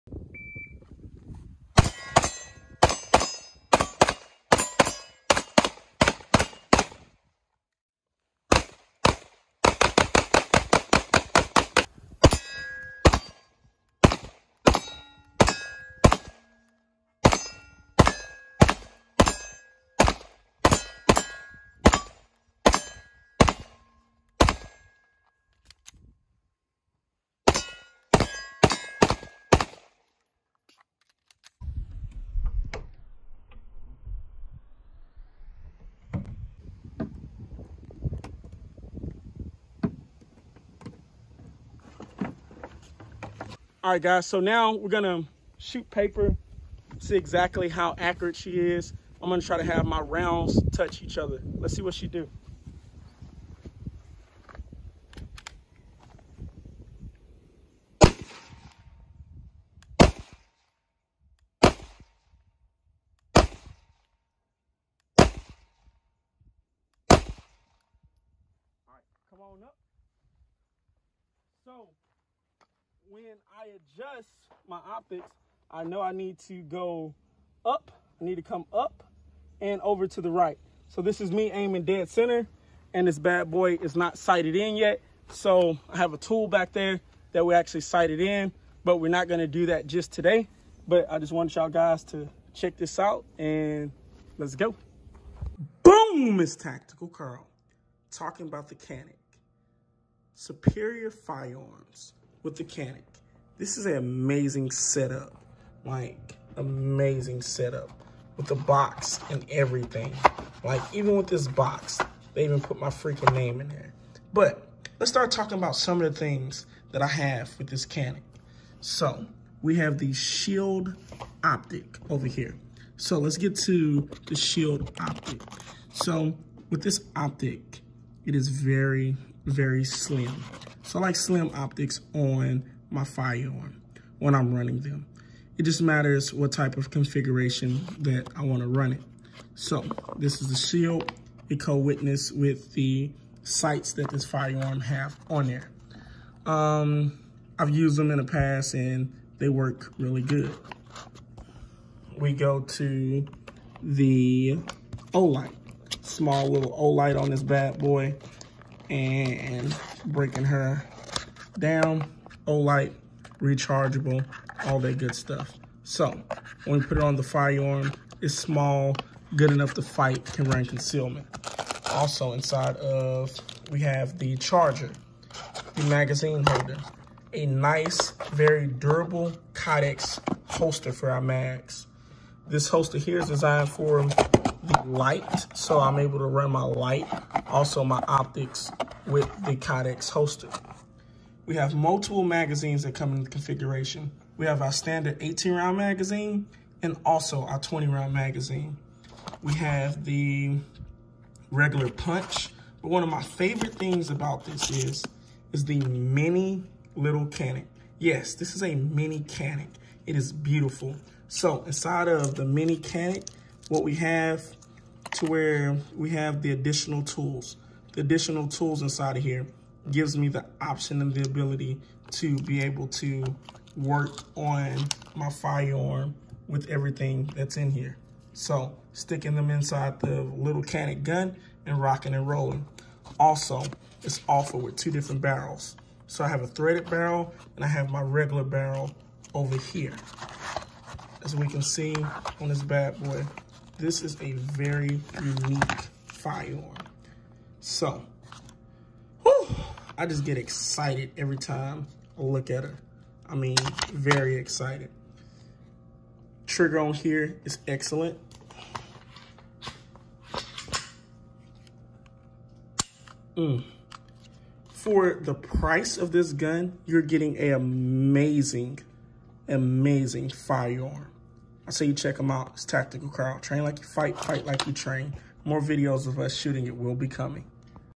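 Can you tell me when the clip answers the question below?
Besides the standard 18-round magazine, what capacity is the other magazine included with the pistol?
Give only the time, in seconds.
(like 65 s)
197 s.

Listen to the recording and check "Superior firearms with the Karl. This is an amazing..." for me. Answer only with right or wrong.
wrong.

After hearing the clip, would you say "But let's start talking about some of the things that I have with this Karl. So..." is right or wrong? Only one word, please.
wrong.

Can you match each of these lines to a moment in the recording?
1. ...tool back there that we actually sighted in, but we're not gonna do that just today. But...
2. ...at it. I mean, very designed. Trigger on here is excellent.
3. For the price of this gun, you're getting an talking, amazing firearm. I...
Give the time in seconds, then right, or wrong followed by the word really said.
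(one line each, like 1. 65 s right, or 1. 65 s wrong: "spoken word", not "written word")
1. 86 s right
2. 252 s wrong: "excited", not "designed"
3. 264 s wrong: "amazing", not "talking".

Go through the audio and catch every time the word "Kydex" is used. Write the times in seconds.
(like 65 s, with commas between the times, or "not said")
179 s, 189 s.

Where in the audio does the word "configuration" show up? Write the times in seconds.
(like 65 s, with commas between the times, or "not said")
136 s, 193 s.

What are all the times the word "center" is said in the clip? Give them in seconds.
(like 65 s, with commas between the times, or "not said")
82 s.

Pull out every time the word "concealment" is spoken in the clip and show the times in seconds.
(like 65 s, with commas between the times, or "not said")
170 s.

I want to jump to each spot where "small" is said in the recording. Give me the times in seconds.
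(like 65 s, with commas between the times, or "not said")
156 s, 168 s.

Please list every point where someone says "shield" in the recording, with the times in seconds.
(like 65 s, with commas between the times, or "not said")
120 s, 124 s, 140 s.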